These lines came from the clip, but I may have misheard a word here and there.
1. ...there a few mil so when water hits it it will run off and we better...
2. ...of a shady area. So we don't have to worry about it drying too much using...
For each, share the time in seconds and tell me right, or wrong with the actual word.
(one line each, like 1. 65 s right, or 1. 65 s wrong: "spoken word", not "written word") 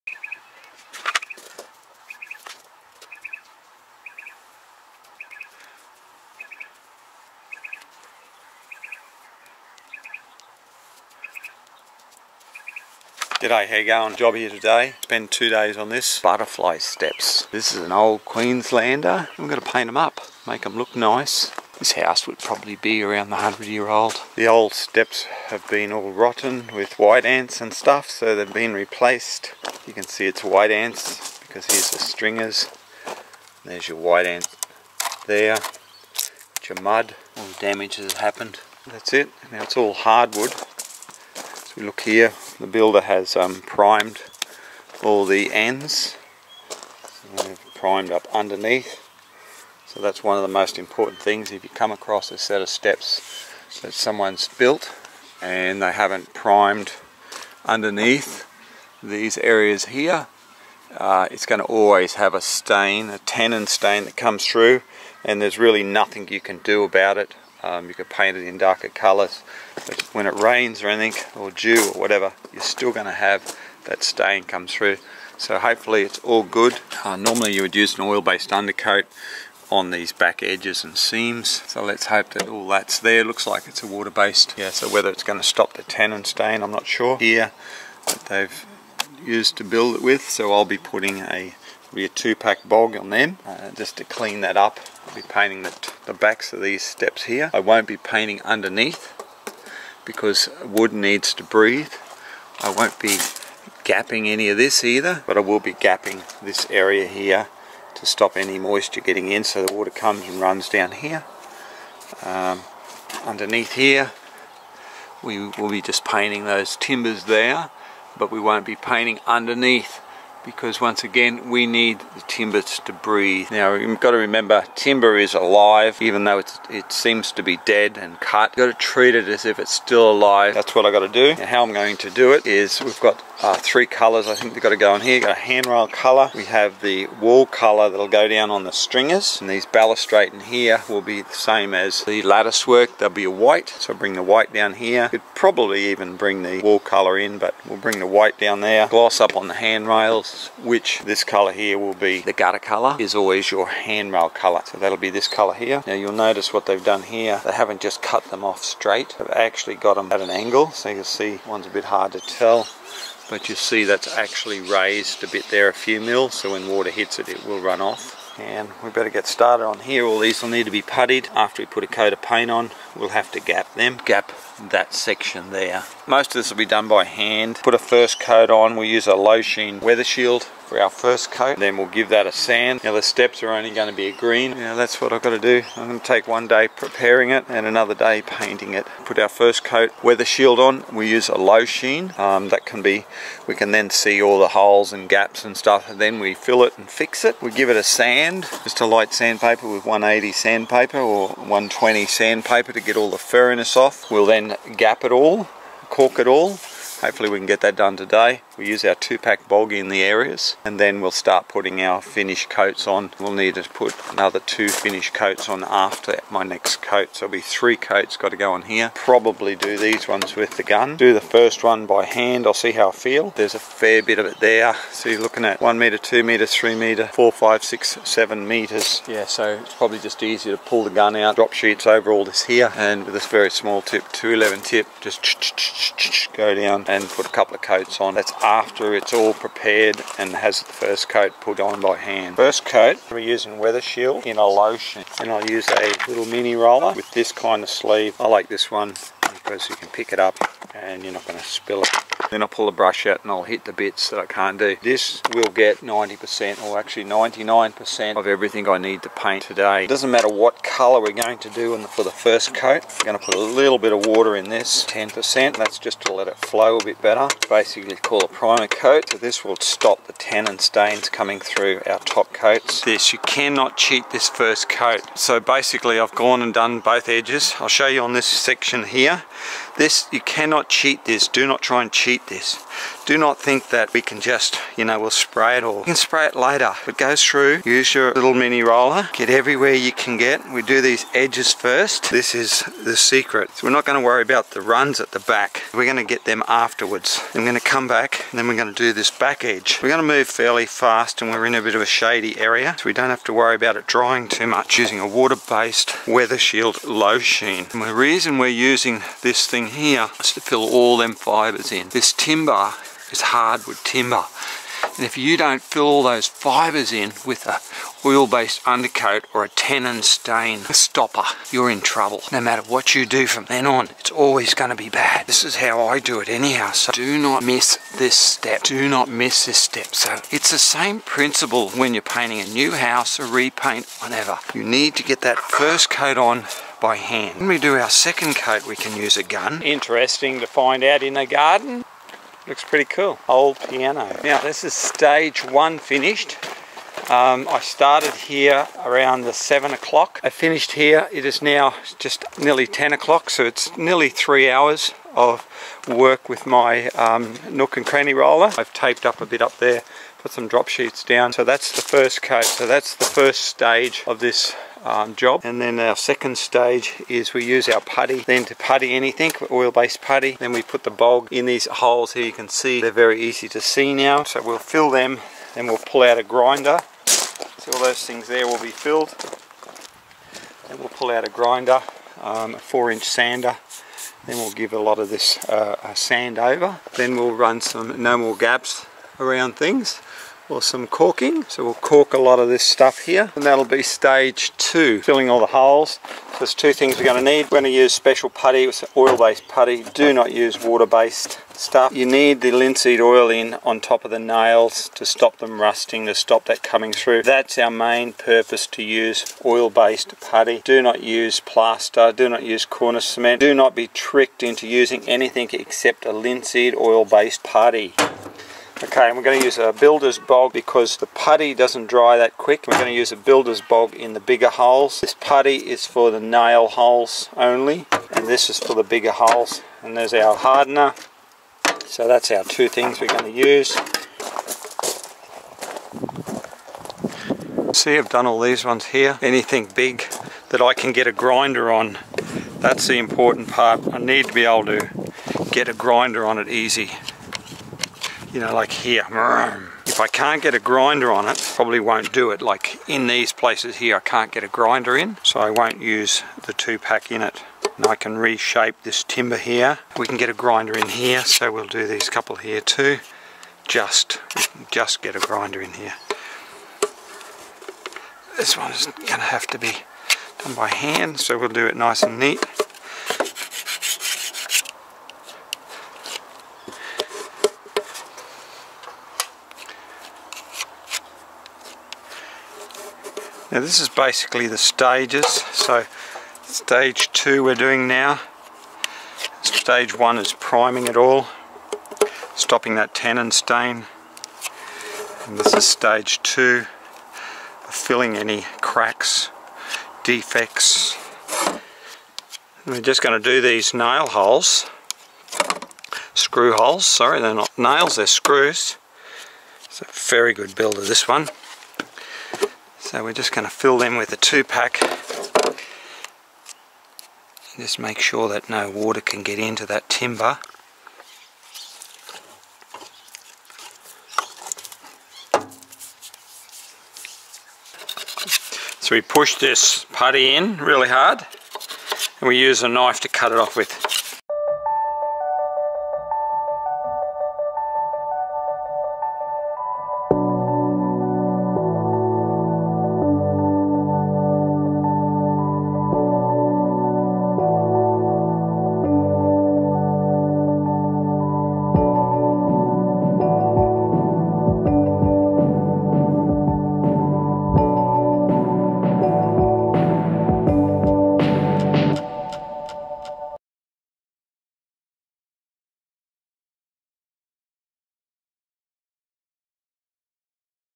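1. 165 s right
2. 301 s right.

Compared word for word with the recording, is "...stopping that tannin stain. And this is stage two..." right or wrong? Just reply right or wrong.
right.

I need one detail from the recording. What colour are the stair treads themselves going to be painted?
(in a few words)
Green.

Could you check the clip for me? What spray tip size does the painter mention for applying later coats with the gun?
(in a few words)
211.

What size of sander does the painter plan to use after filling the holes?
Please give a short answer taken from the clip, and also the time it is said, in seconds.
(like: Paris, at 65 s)
4 inch, at 382 s.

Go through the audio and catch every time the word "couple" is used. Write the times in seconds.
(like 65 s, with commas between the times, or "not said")
237 s, 462 s.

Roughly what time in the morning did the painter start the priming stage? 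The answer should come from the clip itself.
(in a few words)
7 o'clock.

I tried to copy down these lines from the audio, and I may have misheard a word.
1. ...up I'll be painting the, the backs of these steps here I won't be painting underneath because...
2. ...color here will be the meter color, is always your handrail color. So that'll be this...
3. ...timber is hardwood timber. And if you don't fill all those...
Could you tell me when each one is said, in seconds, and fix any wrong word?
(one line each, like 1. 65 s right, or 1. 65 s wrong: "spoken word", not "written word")
1. 94 s right
2. 151 s wrong: "gutter", not "meter"
3. 312 s right.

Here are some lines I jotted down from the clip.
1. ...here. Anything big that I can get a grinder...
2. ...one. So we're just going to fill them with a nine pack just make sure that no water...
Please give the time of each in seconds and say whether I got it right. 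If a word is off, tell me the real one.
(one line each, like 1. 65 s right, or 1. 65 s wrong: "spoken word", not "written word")
1. 438 s right
2. 511 s wrong: "two", not "nine".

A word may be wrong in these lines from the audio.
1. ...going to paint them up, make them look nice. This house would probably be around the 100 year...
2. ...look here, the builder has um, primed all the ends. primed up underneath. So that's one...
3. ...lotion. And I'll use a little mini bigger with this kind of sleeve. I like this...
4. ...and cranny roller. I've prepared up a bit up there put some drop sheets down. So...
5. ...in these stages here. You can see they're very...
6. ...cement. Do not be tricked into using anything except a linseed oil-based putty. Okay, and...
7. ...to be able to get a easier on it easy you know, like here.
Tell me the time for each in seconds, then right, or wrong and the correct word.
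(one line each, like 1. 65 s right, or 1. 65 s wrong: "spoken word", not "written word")
1. 19 s right
2. 41 s right
3. 244 s wrong: "roller", not "bigger"
4. 357 s wrong: "taped", not "prepared"
5. 371 s wrong: "holes", not "stages"
6. 413 s right
7. 444 s wrong: "grinder", not "easier".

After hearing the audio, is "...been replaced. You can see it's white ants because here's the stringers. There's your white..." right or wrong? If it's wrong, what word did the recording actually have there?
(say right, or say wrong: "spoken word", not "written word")
right.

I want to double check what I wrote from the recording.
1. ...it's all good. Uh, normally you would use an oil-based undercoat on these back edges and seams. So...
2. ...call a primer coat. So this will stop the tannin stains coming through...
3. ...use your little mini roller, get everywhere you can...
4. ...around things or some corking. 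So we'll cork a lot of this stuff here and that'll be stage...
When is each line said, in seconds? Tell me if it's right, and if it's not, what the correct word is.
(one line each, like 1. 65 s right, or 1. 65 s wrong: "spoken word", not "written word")
1. 76 s right
2. 267 s right
3. 287 s right
4. 389 s right.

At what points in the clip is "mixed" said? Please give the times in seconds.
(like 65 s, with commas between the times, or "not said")
not said.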